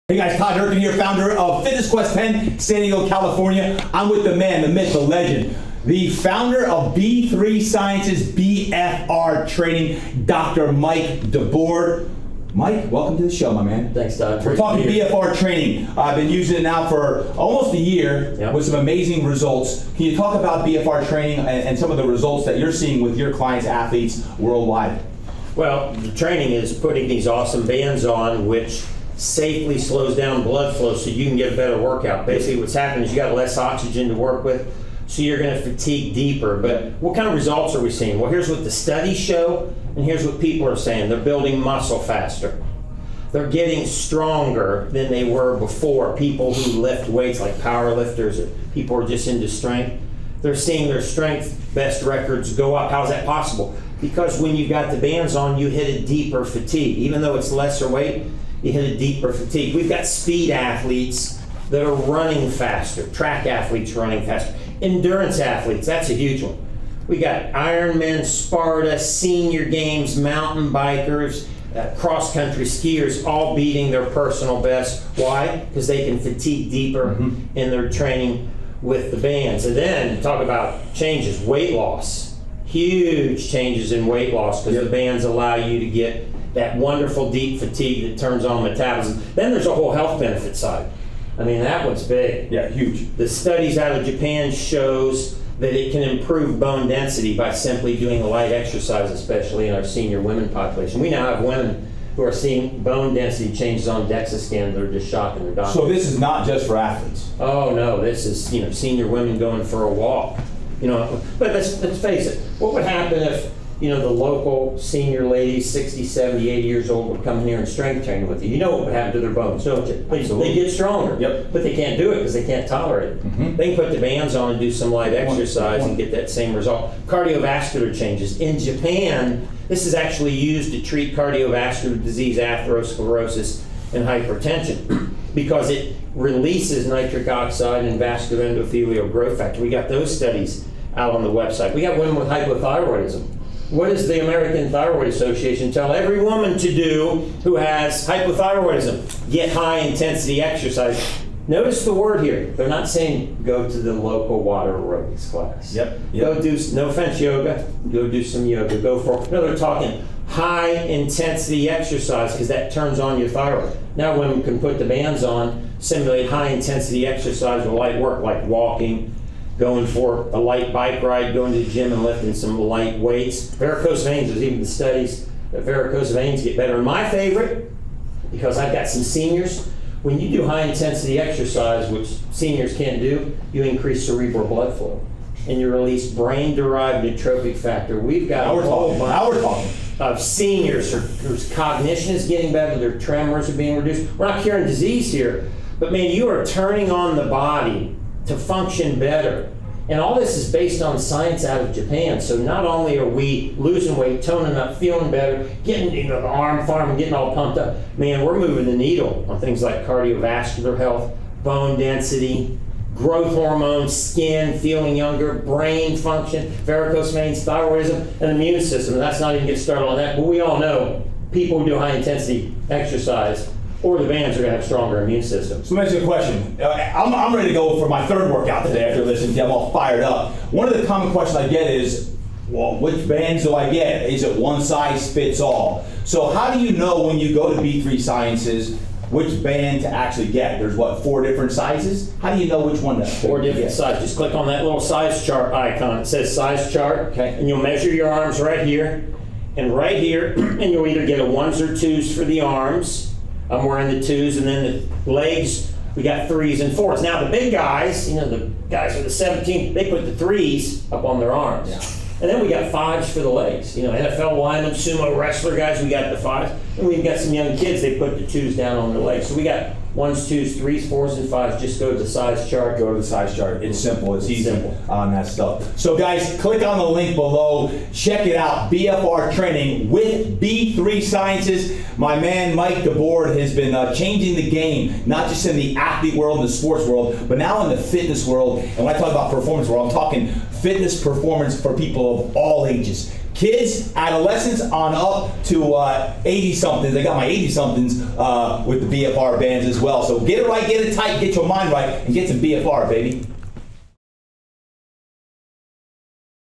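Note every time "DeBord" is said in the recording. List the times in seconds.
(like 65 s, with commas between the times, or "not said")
11 s, 282 s.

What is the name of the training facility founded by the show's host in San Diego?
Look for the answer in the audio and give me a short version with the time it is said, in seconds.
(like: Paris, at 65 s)
Fitness Quest 10, at 1 s.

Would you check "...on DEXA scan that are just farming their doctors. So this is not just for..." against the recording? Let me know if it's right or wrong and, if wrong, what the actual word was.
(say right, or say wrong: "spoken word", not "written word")
wrong: "shocking", not "farming".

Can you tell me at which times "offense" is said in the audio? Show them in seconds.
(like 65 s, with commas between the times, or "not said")
156 s.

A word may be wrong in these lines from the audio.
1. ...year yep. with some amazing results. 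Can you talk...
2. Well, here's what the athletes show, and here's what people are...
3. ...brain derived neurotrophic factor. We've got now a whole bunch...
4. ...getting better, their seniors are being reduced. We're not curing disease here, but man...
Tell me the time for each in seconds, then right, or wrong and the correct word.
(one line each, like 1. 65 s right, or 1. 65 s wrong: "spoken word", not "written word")
1. 17 s right
2. 38 s wrong: "studies", not "athletes"
3. 186 s right
4. 192 s wrong: "tremors", not "seniors".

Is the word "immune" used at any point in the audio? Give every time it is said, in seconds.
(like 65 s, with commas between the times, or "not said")
218 s, 225 s.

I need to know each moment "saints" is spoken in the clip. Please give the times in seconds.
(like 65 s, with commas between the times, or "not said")
not said.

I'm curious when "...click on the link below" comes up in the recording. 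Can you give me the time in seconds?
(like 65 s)
276 s.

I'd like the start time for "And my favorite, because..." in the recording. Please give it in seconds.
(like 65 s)
176 s.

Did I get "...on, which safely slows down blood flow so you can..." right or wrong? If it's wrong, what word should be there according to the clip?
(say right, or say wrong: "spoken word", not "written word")
right.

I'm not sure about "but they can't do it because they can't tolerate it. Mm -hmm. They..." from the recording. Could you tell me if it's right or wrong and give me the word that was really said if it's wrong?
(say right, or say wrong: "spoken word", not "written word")
right.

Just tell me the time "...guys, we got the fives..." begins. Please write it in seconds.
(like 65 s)
265 s.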